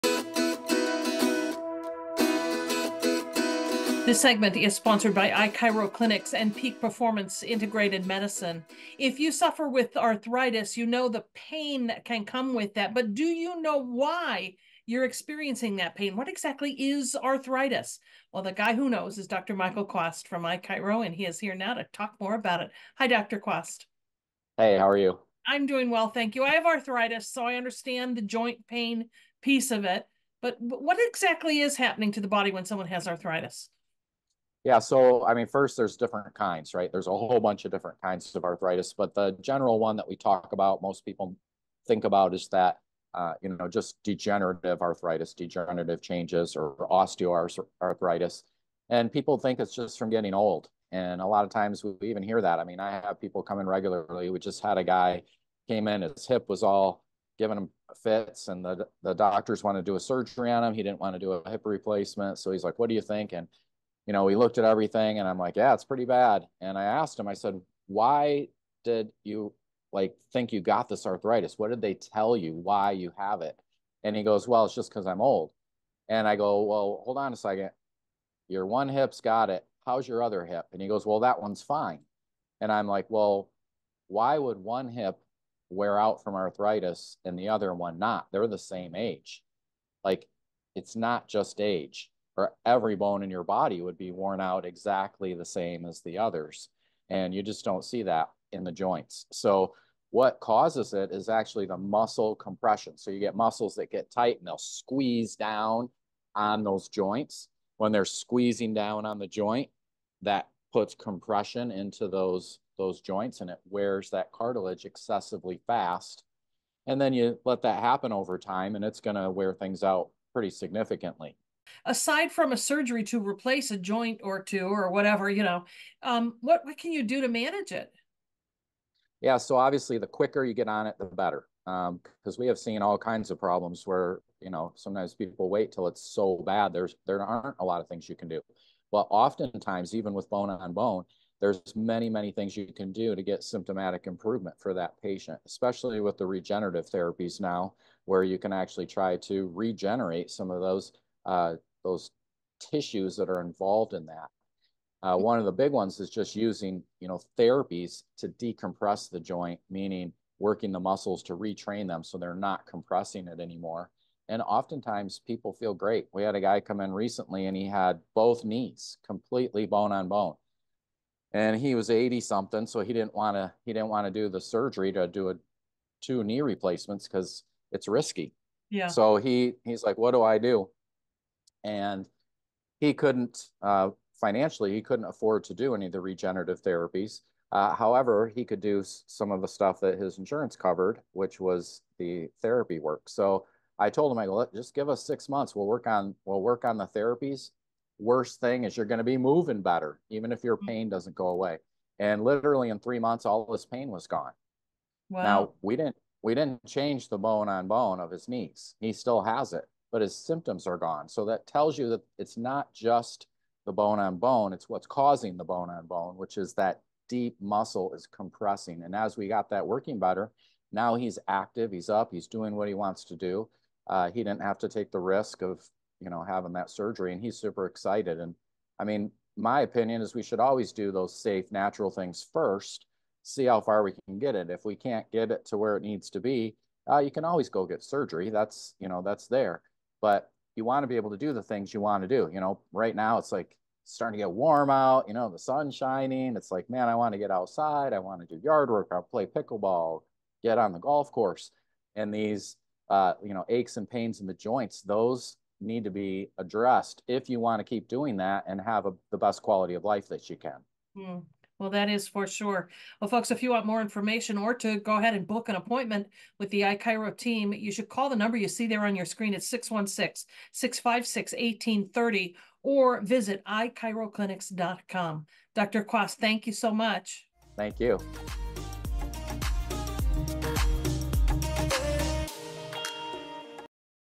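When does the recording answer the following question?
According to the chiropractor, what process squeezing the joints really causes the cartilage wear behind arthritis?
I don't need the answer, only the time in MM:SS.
01:41.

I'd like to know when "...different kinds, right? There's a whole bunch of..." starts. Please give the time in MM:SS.
00:35.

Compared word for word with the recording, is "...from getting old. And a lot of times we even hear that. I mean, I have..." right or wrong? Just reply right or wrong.
right.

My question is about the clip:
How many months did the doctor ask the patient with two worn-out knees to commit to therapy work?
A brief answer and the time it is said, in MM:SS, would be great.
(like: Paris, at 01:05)
6, at 03:15.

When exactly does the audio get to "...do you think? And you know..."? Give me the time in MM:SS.
01:02.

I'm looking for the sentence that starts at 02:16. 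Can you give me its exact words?
There's There aren't a lot of things you can do.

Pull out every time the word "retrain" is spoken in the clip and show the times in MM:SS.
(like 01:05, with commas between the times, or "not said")
02:41.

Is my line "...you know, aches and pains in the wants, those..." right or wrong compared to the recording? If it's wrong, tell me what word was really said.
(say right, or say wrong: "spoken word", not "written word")
wrong: "joints", not "wants".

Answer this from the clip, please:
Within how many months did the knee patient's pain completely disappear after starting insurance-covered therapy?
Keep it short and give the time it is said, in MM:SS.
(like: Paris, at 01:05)
3, at 03:22.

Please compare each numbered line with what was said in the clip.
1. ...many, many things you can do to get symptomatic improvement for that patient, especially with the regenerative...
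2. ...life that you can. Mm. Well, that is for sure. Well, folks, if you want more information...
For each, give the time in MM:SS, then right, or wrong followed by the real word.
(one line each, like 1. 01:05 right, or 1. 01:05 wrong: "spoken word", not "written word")
1. 02:21 right
2. 04:19 right.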